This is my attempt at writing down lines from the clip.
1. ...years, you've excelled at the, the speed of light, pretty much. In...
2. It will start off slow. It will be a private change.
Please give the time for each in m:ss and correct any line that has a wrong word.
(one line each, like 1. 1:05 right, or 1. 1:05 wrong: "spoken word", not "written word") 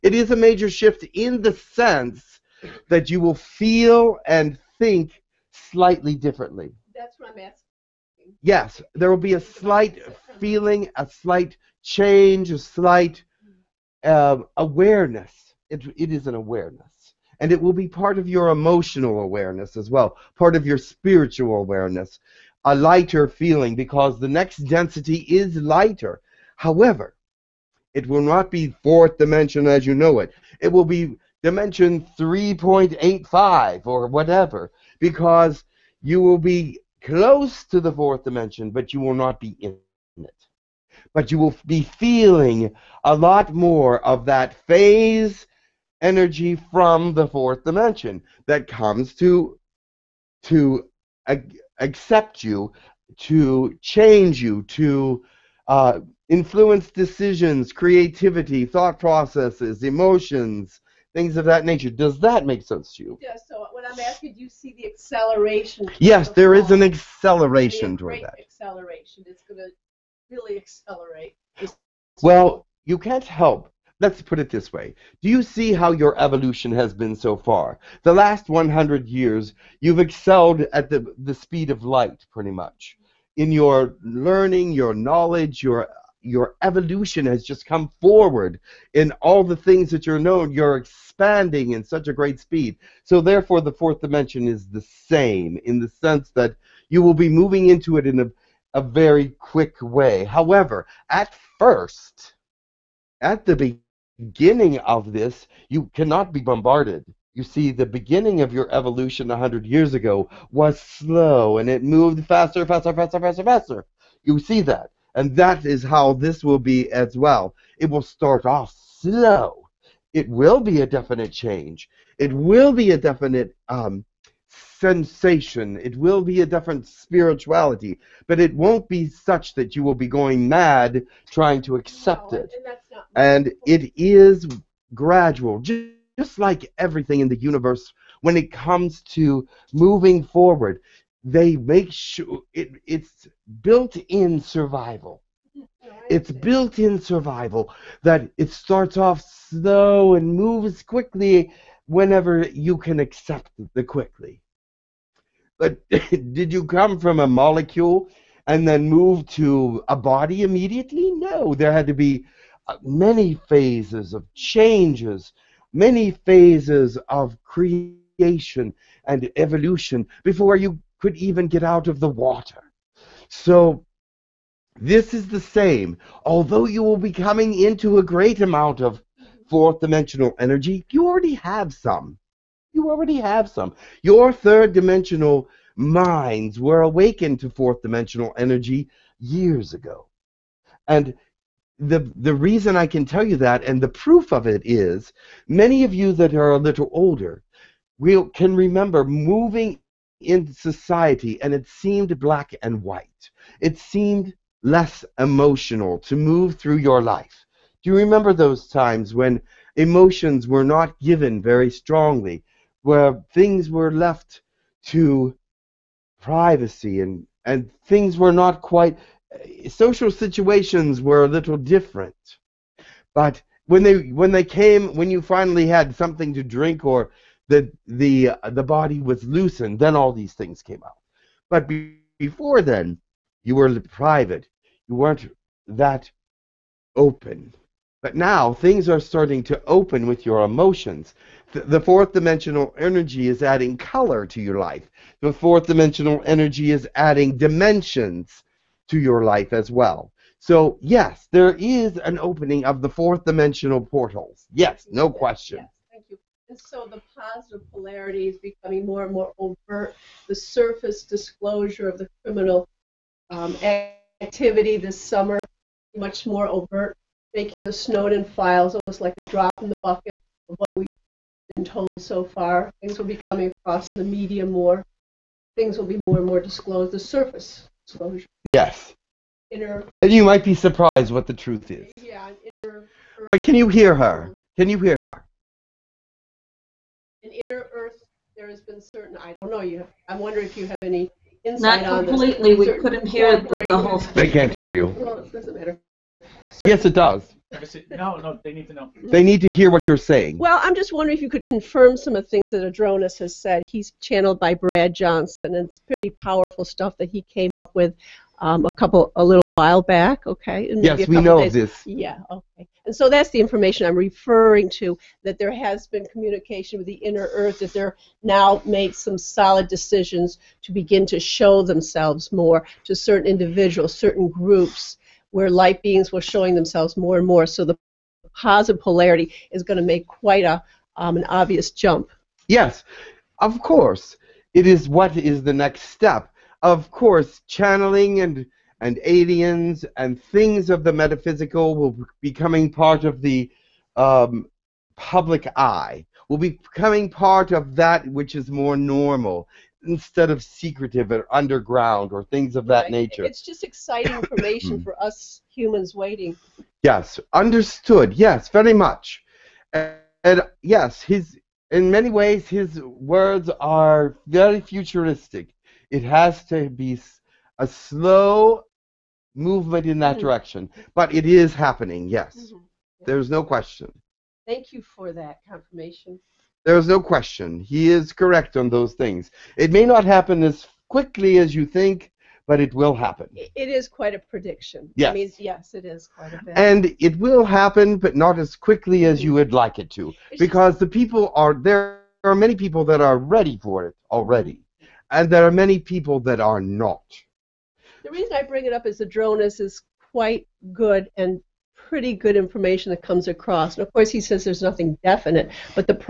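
1. 1:19 right
2. 1:57 wrong: "definite", not "private".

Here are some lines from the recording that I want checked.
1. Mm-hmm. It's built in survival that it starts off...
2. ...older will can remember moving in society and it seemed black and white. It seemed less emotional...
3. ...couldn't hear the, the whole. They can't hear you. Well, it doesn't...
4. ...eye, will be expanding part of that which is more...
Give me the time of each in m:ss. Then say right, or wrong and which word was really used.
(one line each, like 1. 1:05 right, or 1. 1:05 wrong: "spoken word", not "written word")
1. 2:25 right
2. 3:16 right
3. 4:52 right
4. 5:45 wrong: "becoming", not "expanding".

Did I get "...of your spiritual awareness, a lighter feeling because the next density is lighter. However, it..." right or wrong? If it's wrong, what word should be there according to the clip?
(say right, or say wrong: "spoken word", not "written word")
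right.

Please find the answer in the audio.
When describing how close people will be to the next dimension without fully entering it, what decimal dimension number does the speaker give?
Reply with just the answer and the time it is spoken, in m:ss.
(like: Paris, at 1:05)
3.85, at 0:32.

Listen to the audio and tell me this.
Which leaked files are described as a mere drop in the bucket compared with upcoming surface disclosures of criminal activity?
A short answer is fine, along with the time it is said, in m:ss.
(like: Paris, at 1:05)
The Snowden files, at 4:27.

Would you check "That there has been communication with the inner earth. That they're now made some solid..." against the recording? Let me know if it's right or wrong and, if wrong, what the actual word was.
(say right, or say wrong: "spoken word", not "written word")
right.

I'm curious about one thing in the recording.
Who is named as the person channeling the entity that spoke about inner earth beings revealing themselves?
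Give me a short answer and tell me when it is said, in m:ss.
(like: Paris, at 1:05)
Brad Johnson, at 5:04.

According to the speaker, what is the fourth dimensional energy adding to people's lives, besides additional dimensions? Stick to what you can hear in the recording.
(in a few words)
Color.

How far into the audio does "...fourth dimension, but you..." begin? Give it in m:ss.
0:37.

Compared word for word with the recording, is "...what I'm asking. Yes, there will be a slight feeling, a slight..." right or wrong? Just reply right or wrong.
right.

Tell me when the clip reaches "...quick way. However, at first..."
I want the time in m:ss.
1:39.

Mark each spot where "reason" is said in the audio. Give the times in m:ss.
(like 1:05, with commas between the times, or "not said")
3:12, 6:38.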